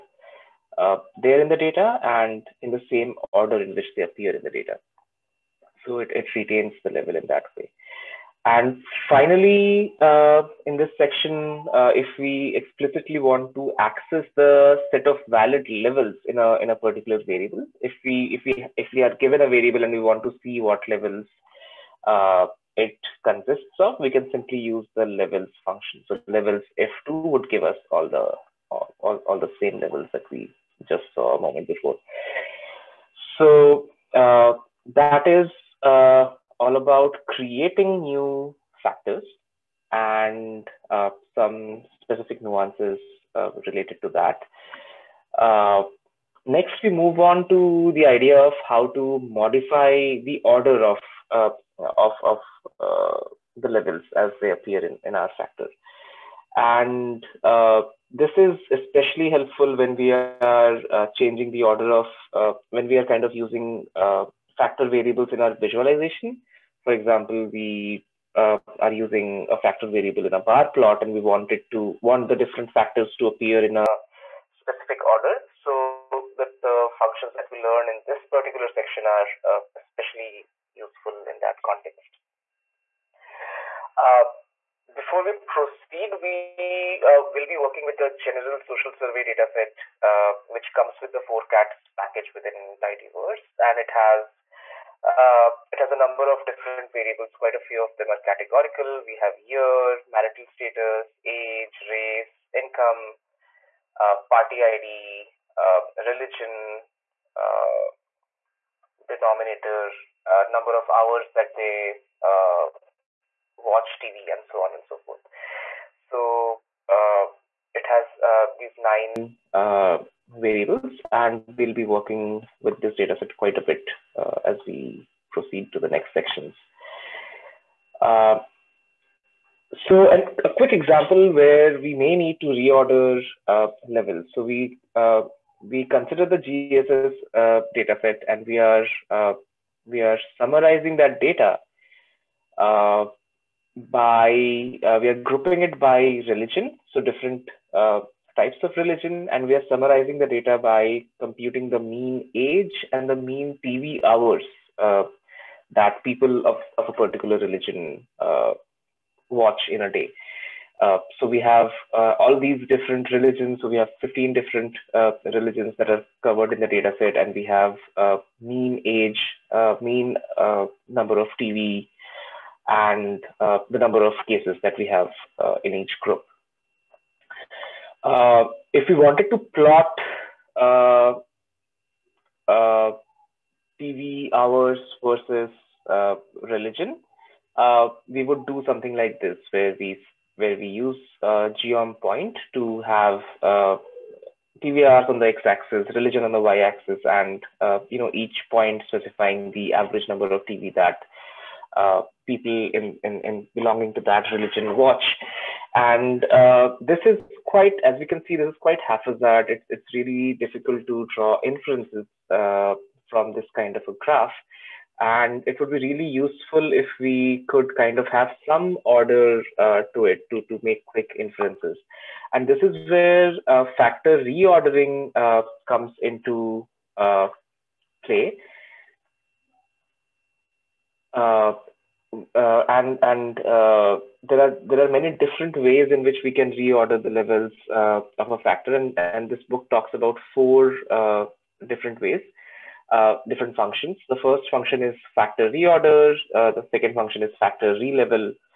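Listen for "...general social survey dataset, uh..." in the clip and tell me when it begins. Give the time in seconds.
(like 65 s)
88 s.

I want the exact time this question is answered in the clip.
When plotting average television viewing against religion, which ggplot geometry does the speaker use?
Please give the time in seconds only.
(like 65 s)
191 s.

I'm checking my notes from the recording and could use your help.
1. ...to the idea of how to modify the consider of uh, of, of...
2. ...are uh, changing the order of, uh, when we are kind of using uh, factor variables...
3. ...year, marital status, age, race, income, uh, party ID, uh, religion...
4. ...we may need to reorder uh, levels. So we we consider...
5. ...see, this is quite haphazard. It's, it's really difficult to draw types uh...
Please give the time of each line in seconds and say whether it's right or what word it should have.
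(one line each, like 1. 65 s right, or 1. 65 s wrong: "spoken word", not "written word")
1. 47 s wrong: "order", not "consider"
2. 60 s right
3. 99 s right
4. 131 s right
5. 208 s wrong: "inferences", not "types".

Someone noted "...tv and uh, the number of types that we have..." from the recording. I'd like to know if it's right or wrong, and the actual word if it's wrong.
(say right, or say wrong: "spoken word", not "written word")
wrong: "cases", not "types".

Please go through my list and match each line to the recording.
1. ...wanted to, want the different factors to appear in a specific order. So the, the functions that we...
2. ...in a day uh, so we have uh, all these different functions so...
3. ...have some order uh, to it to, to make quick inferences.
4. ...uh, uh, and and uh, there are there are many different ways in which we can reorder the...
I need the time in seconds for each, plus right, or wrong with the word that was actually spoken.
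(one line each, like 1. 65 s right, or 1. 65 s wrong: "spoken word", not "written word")
1. 71 s right
2. 159 s wrong: "religions", not "functions"
3. 218 s right
4. 231 s right.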